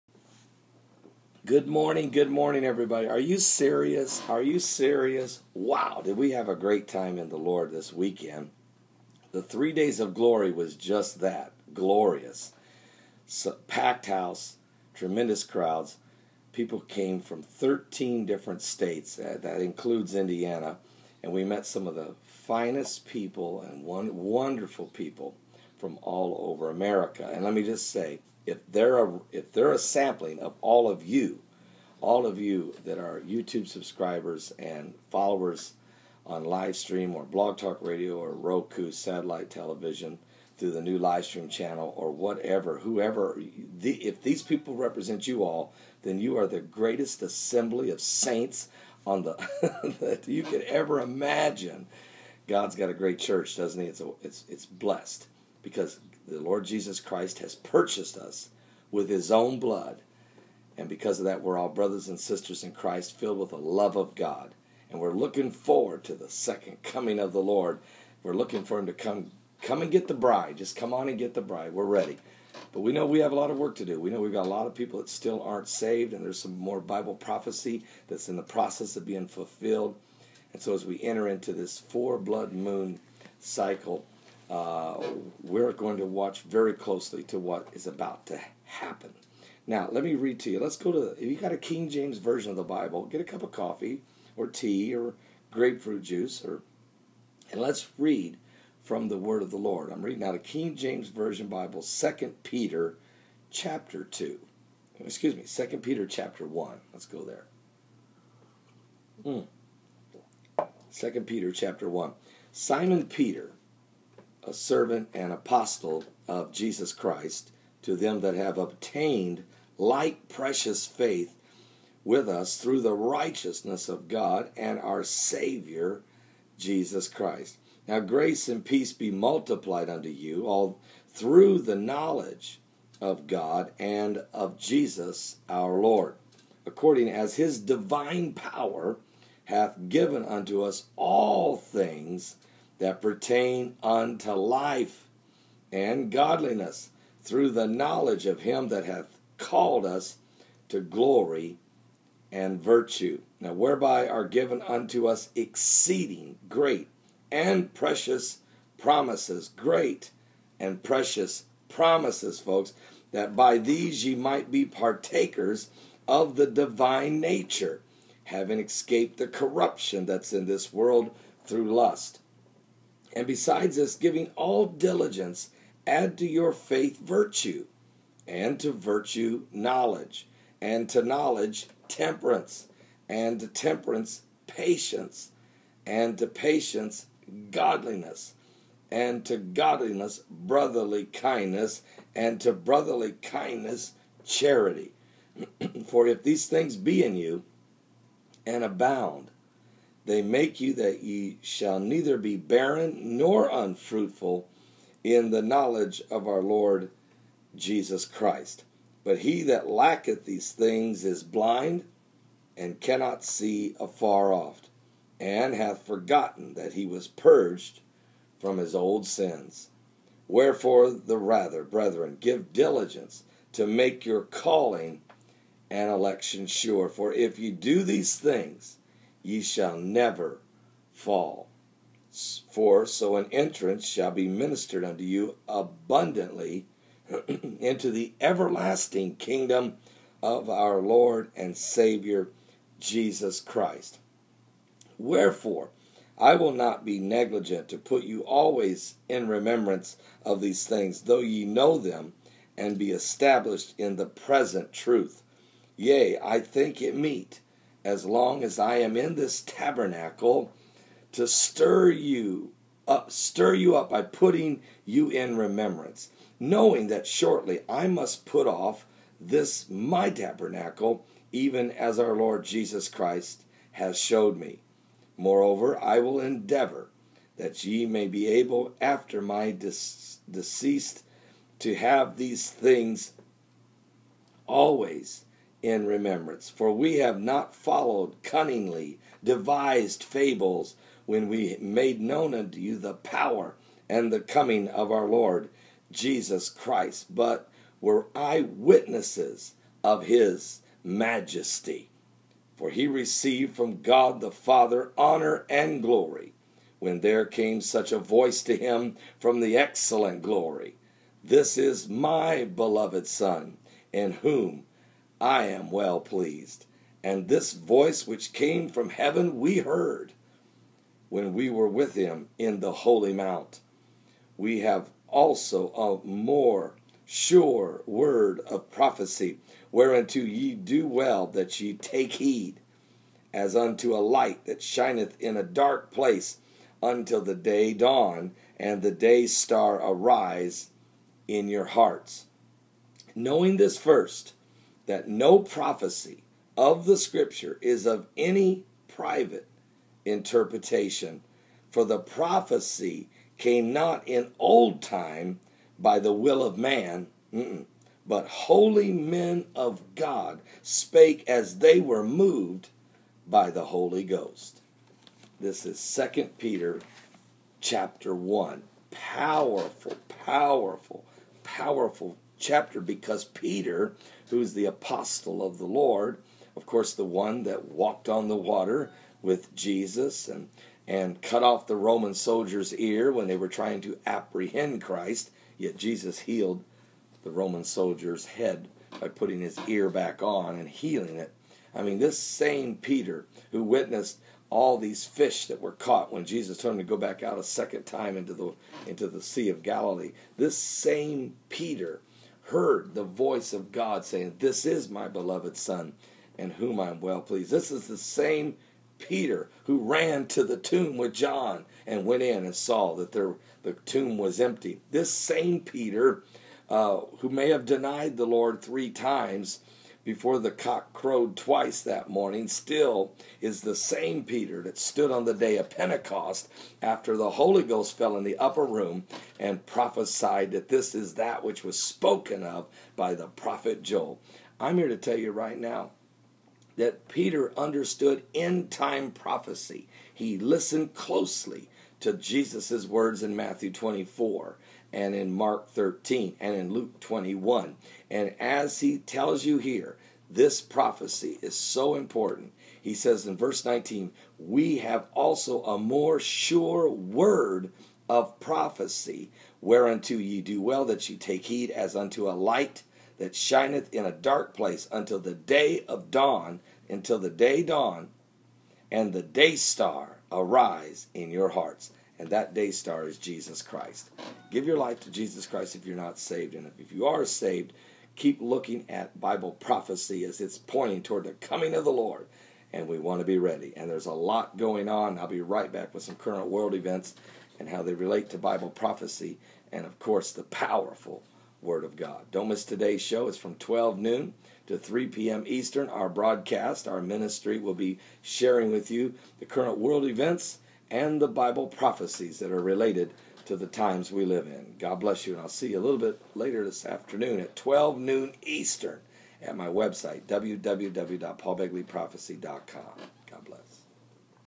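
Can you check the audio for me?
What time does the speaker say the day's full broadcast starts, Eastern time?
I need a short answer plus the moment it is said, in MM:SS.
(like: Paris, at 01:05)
12 noon, at 08:13.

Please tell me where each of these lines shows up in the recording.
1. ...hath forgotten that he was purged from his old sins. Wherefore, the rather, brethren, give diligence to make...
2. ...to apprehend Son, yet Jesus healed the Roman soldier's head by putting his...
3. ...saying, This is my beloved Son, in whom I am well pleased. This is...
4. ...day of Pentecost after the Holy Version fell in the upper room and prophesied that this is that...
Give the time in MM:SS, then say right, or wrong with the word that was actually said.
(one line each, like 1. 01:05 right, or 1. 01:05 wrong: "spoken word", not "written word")
1. 03:35 right
2. 06:23 wrong: "Christ", not "Son"
3. 06:44 right
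4. 07:05 wrong: "Ghost", not "Version".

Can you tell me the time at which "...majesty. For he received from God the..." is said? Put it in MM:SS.
05:00.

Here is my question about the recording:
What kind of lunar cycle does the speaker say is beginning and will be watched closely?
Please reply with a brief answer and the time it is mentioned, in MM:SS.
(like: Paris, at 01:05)
four blood moon, at 01:21.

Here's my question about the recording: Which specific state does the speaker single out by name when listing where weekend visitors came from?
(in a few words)
Indiana.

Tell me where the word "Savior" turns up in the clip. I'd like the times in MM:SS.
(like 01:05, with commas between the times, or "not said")
02:05, 04:01.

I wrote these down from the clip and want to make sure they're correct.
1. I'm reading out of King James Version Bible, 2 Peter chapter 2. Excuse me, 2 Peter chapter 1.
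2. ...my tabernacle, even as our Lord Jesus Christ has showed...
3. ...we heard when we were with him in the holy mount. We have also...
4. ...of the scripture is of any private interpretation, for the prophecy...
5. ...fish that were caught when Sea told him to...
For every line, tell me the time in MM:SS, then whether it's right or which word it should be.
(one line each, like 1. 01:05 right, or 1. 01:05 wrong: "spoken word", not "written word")
1. 01:39 right
2. 04:29 right
3. 05:19 right
4. 05:46 right
5. 06:35 wrong: "Jesus", not "Sea".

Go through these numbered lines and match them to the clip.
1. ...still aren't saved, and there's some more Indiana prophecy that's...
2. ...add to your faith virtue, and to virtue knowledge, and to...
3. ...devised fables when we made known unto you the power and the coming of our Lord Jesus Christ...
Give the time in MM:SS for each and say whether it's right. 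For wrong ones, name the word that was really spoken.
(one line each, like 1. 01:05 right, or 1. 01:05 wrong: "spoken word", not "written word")
1. 01:15 wrong: "Bible", not "Indiana"
2. 02:55 right
3. 04:49 right.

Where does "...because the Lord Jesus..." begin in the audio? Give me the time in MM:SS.
00:55.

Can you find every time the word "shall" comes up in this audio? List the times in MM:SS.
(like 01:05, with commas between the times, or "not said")
03:21, 03:49, 03:53.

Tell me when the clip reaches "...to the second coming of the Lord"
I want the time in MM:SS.
01:06.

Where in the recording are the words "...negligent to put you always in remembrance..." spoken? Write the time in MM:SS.
04:06.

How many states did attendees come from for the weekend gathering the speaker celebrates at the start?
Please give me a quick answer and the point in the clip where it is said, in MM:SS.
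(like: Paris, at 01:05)
13, at 00:17.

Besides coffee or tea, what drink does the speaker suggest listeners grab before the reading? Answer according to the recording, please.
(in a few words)
grapefruit juice.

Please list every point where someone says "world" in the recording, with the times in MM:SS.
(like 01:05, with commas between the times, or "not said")
02:50, 08:06, 08:19.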